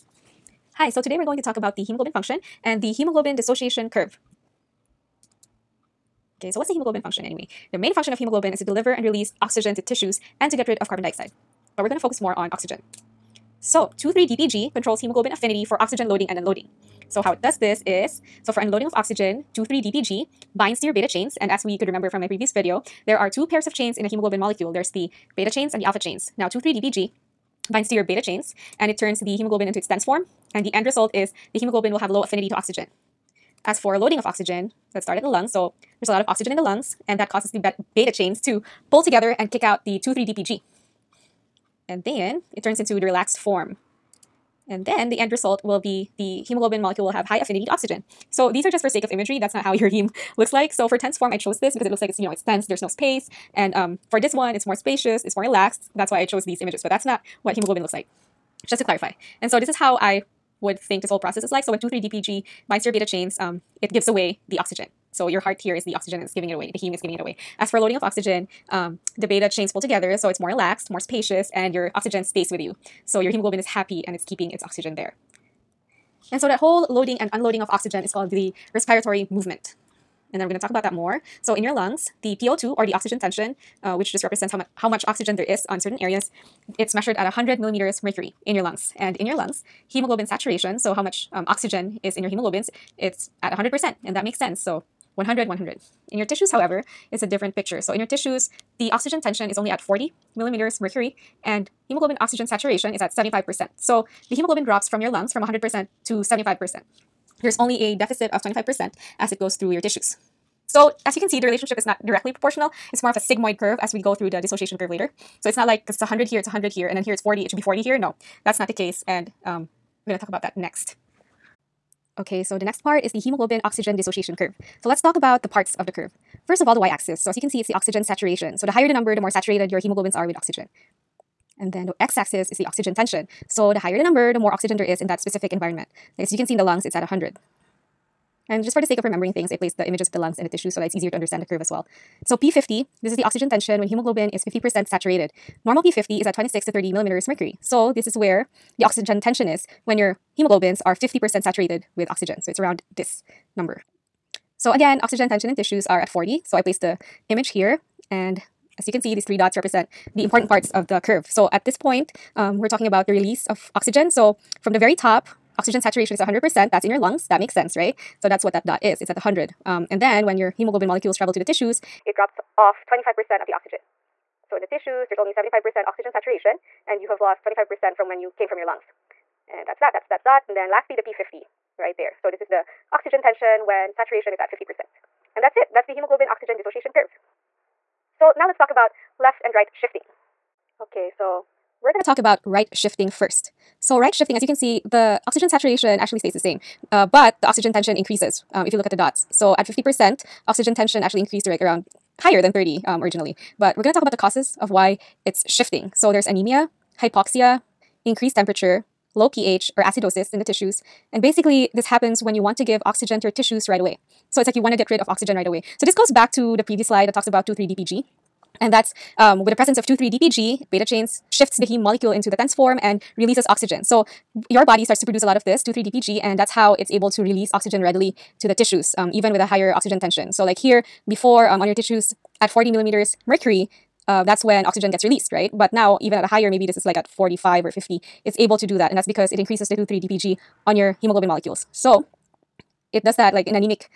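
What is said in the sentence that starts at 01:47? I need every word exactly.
There's only a deficit of 25% as it goes through your tissues.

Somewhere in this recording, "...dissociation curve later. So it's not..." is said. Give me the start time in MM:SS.
01:54.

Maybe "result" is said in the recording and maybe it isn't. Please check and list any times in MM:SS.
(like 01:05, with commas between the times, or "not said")
00:30, 00:45.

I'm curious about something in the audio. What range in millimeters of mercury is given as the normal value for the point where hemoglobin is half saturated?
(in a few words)
26 to 30.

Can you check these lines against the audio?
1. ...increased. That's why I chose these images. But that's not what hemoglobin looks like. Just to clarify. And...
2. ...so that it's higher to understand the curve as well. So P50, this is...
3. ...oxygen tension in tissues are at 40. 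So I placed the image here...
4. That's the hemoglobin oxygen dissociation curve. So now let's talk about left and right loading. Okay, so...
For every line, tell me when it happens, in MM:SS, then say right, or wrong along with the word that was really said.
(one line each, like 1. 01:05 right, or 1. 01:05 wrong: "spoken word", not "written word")
1. 00:55 wrong: "relaxed", not "increased"
2. 02:20 wrong: "easier", not "higher"
3. 02:35 right
4. 03:05 wrong: "shifting", not "loading".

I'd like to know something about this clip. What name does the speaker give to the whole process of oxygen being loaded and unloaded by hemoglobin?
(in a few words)
respiratory movement.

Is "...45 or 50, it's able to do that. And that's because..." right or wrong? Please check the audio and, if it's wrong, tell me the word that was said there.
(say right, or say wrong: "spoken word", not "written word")
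right.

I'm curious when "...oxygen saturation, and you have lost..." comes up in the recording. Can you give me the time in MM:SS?
02:55.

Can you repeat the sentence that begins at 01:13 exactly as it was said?
So your hemoglobin is happy and it's keeping its oxygen there.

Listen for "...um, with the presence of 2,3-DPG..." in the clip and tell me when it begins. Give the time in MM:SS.
03:39.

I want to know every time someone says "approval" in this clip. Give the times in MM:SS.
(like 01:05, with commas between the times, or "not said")
not said.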